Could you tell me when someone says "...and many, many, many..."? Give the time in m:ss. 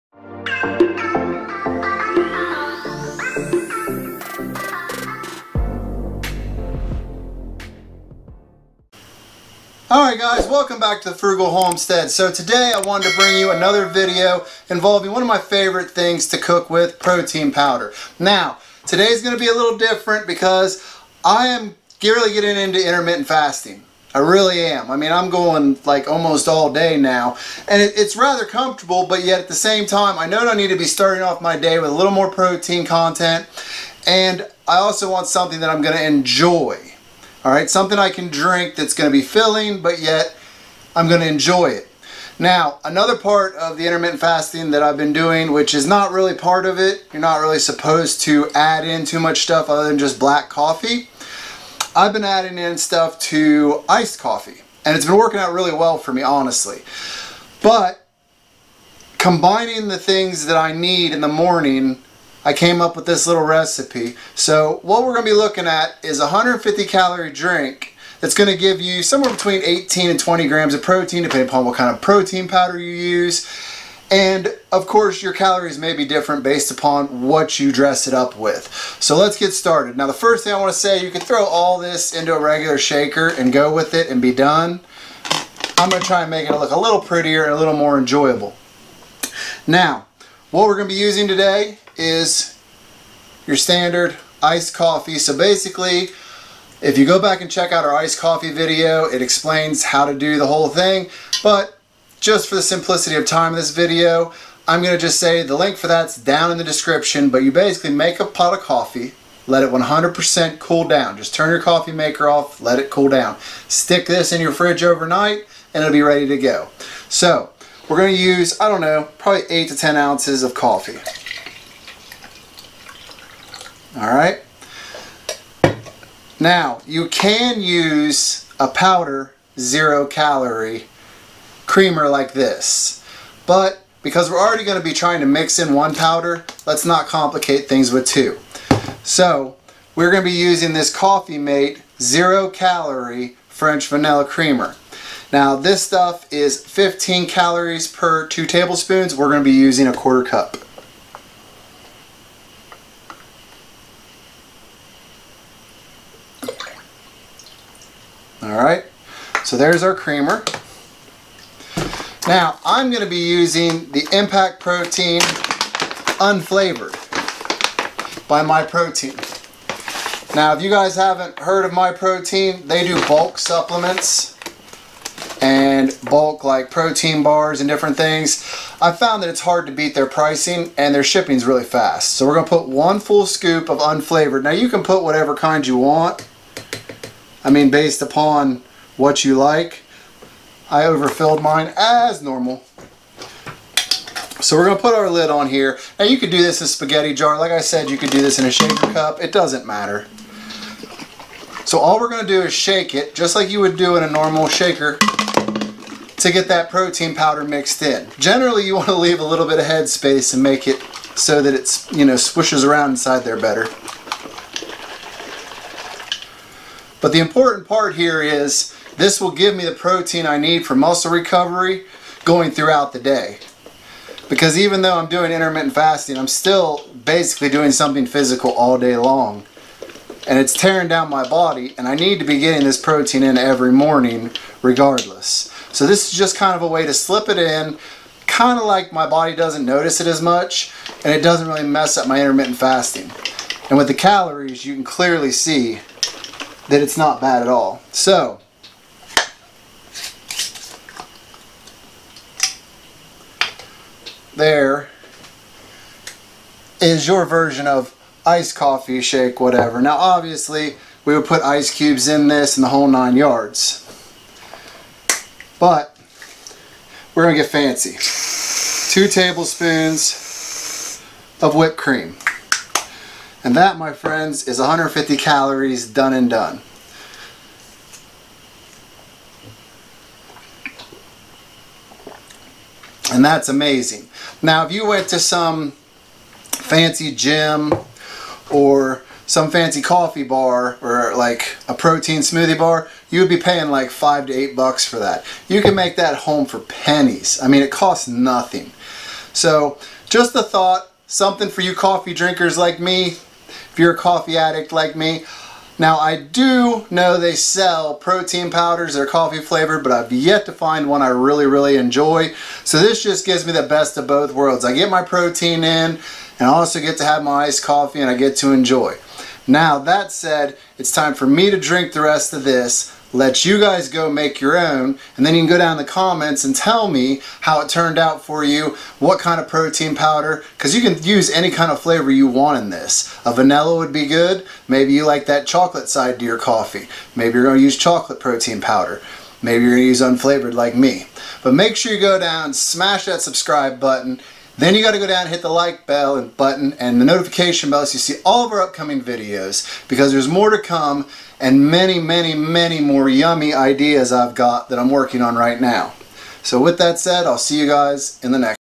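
5:51.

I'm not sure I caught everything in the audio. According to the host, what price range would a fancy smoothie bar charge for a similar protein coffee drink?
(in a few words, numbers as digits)
5 to 8 bucks.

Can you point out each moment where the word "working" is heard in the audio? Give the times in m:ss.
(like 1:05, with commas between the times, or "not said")
0:55, 5:54.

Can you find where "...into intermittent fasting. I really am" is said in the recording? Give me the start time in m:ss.
0:22.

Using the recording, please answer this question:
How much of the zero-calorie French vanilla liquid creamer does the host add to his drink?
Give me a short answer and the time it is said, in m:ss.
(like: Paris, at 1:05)
a quarter cup, at 2:29.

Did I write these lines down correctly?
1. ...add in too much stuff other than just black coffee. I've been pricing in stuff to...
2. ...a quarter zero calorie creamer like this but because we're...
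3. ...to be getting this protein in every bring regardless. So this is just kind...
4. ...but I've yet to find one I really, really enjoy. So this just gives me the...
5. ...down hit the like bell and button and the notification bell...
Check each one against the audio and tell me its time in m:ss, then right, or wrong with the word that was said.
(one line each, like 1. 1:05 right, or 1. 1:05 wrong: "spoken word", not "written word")
1. 0:48 wrong: "adding", not "pricing"
2. 2:08 wrong: "powder", not "quarter"
3. 3:52 wrong: "morning", not "bring"
4. 5:09 right
5. 5:45 right.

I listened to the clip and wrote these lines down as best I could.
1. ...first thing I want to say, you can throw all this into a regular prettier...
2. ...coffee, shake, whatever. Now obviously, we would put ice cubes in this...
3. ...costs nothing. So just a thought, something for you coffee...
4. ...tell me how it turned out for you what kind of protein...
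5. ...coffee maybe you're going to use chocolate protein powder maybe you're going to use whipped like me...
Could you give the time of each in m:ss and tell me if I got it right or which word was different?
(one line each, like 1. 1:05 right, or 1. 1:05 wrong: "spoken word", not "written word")
1. 1:20 wrong: "shaker", not "prettier"
2. 4:18 right
3. 4:57 right
4. 5:26 right
5. 5:36 wrong: "unflavored", not "whipped".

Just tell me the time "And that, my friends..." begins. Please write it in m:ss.
4:33.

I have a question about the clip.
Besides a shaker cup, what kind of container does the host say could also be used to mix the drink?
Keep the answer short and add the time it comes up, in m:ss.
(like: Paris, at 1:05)
spaghetti jar, at 3:16.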